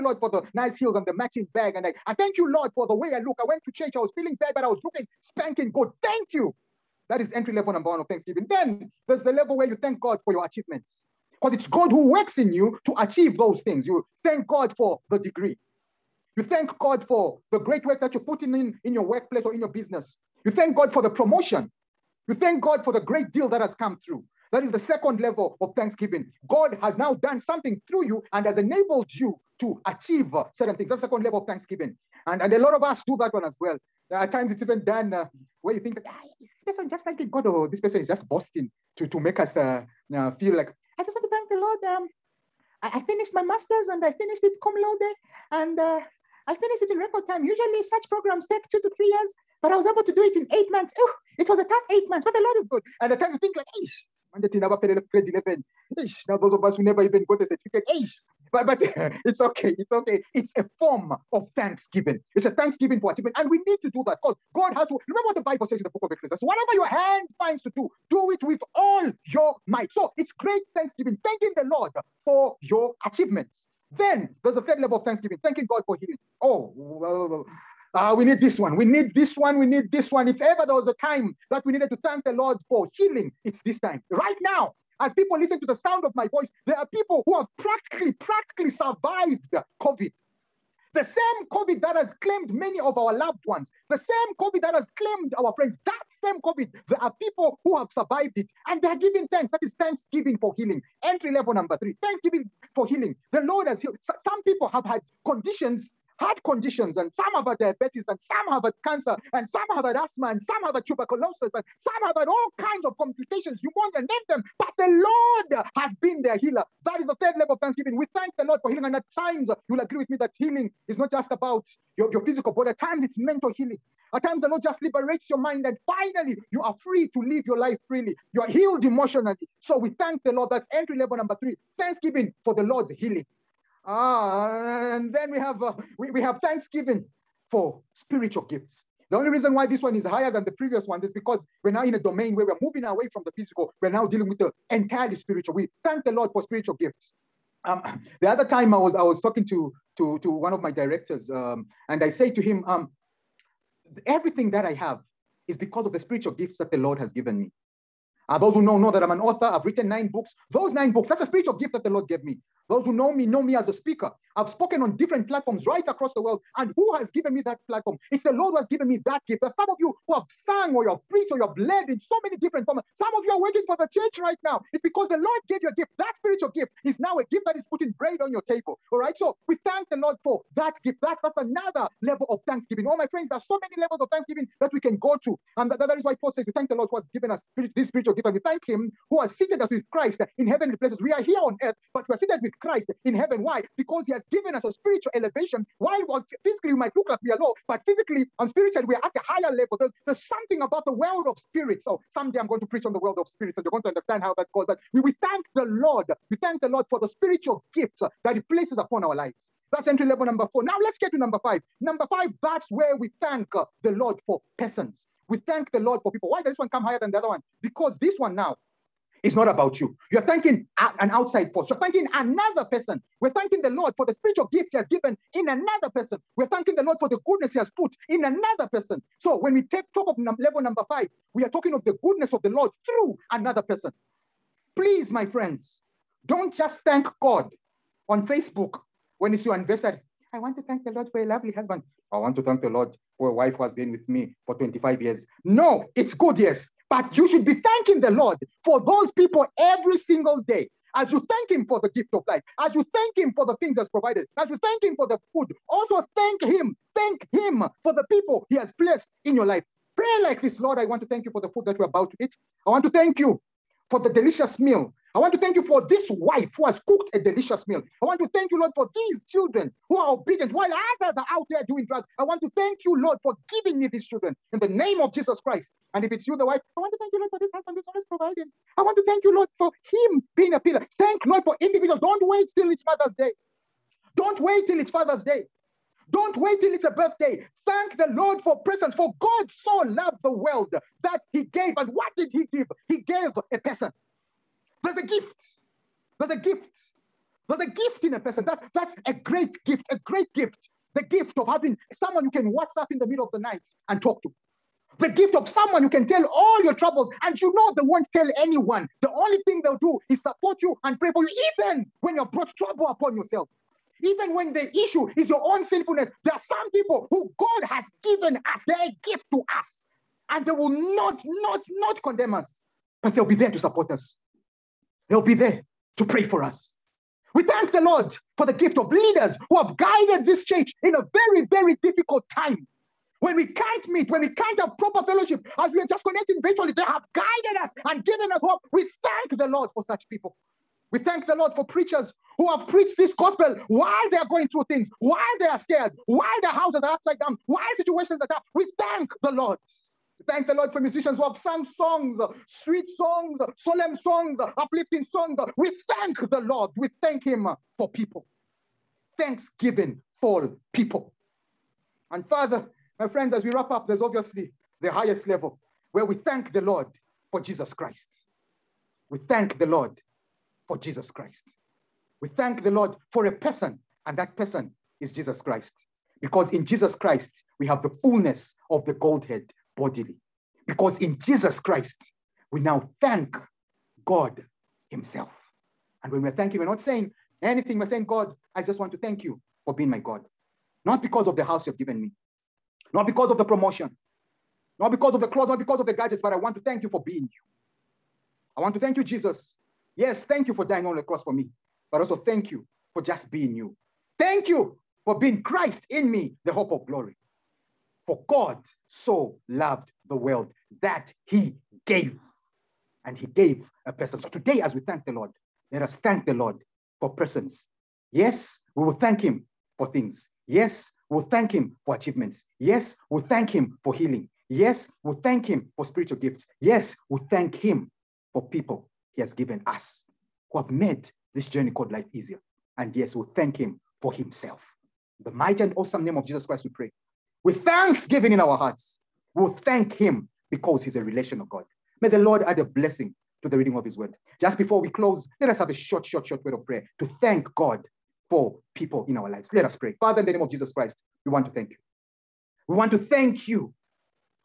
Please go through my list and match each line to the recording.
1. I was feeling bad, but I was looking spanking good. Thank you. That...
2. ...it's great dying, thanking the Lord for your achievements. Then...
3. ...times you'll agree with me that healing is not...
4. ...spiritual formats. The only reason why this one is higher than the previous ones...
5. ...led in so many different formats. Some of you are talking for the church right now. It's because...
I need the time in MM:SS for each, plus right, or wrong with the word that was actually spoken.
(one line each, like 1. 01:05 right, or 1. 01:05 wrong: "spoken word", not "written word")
1. 00:03 right
2. 01:10 wrong: "thanksgiving", not "dying"
3. 01:59 right
4. 02:17 wrong: "gifts", not "formats"
5. 02:51 wrong: "working", not "talking".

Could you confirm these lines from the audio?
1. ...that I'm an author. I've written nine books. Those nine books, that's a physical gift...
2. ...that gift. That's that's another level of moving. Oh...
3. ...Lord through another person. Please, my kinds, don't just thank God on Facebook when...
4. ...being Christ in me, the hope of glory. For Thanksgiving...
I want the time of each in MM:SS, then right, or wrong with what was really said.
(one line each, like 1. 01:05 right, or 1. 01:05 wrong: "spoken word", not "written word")
1. 02:38 wrong: "spiritual", not "physical"
2. 03:00 wrong: "thanksgiving", not "moving"
3. 03:52 wrong: "friends", not "kinds"
4. 06:45 wrong: "God", not "Thanksgiving".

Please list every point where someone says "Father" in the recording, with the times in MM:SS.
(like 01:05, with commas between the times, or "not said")
04:44, 06:02, 07:30.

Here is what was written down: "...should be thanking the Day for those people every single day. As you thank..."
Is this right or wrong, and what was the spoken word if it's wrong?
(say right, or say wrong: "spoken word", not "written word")
wrong: "Lord", not "Day".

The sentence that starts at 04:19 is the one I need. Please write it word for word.
Pray like this Lord, I want to thank you for the food that we're about to eat.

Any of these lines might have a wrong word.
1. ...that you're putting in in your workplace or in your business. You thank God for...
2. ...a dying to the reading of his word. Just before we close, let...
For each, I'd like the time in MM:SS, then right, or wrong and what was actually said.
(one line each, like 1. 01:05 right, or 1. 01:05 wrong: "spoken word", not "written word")
1. 00:18 right
2. 07:22 wrong: "blessing", not "dying".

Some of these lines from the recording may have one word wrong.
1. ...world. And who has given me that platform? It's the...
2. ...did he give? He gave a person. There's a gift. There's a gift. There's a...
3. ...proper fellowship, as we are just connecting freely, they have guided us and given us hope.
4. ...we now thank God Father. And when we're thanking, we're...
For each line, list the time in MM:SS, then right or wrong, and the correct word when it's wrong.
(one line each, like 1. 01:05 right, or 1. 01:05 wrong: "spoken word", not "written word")
1. 02:46 right
2. 04:52 right
3. 05:34 wrong: "virtually", not "freely"
4. 06:22 wrong: "Himself", not "Father".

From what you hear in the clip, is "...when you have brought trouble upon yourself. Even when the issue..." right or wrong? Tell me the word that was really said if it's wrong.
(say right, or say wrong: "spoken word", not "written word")
right.